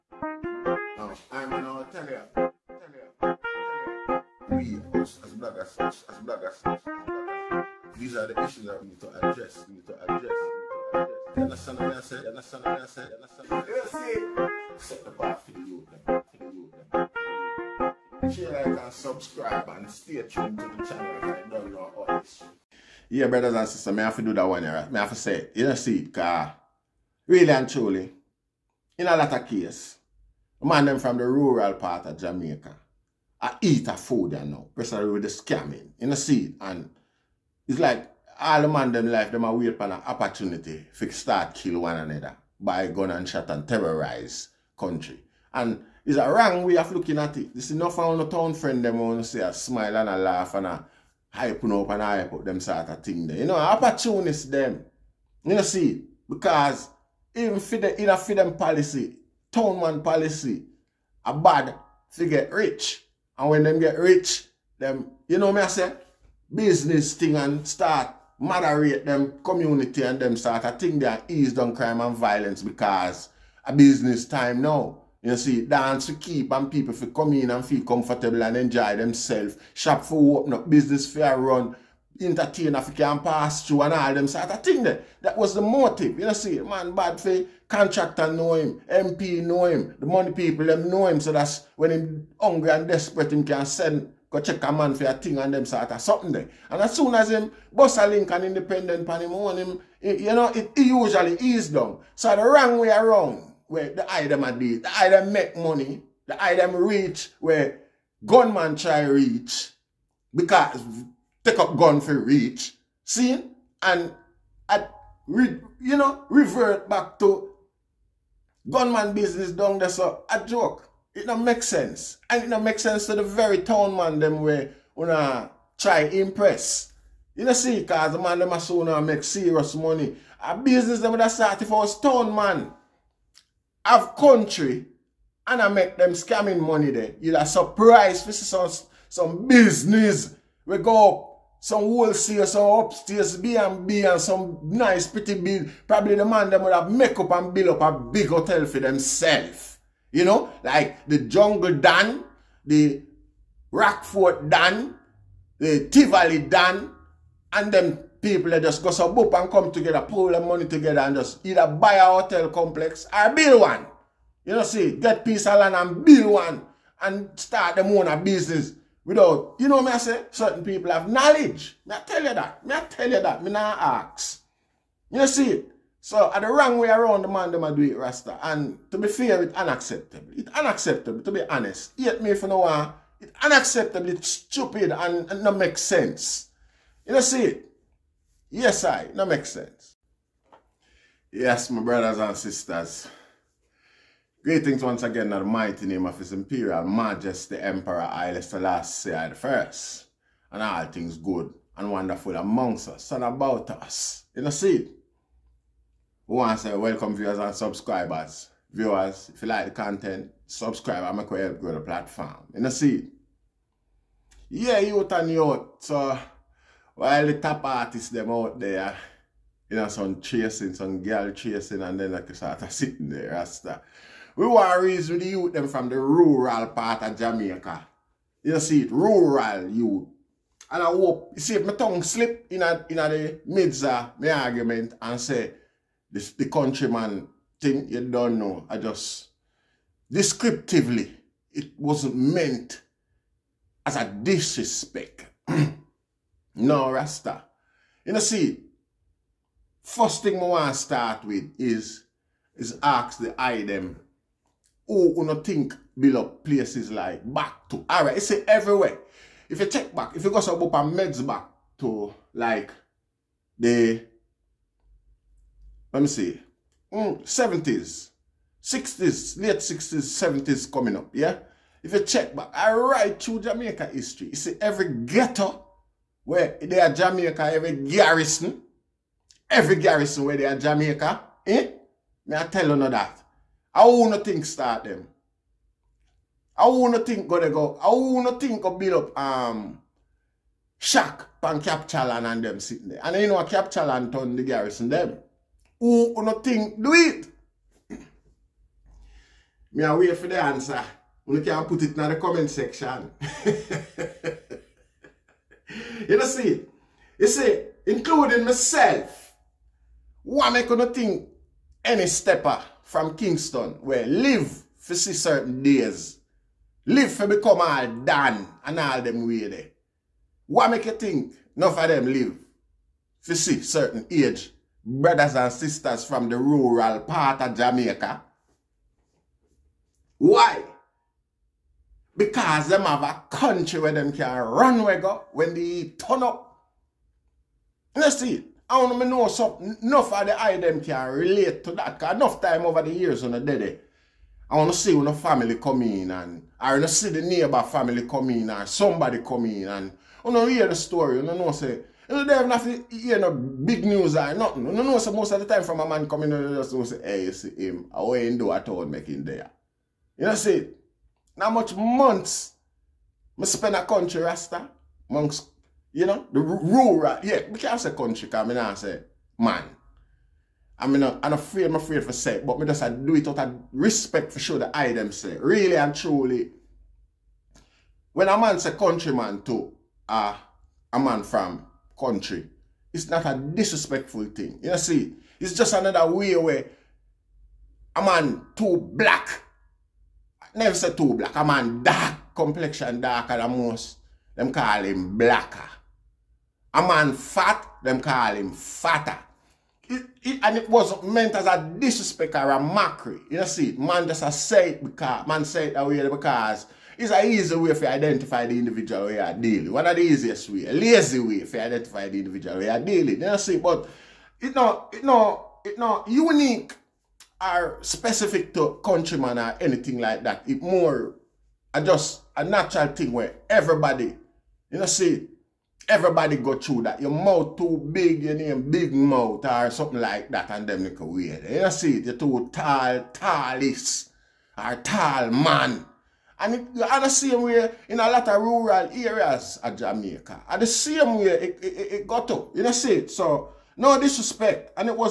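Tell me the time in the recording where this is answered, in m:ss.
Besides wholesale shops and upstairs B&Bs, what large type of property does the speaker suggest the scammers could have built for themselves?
2:27.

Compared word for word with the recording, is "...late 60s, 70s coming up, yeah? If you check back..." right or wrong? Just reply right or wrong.
right.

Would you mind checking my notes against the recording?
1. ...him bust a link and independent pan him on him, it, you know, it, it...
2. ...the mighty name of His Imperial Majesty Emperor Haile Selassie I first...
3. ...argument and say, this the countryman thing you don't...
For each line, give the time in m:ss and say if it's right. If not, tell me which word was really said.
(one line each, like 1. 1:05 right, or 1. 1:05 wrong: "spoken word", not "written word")
1. 1:37 right
2. 3:15 right
3. 3:54 right.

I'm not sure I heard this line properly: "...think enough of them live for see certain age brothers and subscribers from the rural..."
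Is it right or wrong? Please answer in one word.
wrong.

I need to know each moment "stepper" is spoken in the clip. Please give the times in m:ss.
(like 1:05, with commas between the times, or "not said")
5:12.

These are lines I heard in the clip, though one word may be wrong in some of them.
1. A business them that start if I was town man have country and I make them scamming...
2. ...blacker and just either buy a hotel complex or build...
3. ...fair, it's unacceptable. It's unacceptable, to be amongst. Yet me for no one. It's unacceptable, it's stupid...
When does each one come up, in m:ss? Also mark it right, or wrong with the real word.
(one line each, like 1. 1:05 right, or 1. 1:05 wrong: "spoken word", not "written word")
1. 2:10 right
2. 2:40 wrong: "together", not "blacker"
3. 2:59 wrong: "honest", not "amongst".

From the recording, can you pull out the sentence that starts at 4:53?
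And you know a capture land turn the garrison them who no think do it?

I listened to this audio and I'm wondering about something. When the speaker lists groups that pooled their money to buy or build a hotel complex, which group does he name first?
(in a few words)
Jungle Dan.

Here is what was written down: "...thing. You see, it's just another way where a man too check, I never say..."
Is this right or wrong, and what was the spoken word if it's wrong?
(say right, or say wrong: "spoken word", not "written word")
wrong: "black", not "check".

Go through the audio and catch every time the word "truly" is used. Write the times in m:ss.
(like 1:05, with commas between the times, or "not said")
0:27, 6:15.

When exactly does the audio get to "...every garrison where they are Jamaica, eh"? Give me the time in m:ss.
4:39.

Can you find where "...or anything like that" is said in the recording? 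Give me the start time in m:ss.
6:59.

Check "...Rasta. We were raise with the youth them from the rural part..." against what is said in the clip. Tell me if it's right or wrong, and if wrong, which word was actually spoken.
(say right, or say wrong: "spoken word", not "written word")
right.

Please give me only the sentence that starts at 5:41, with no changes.
Because enough time over the years on the day.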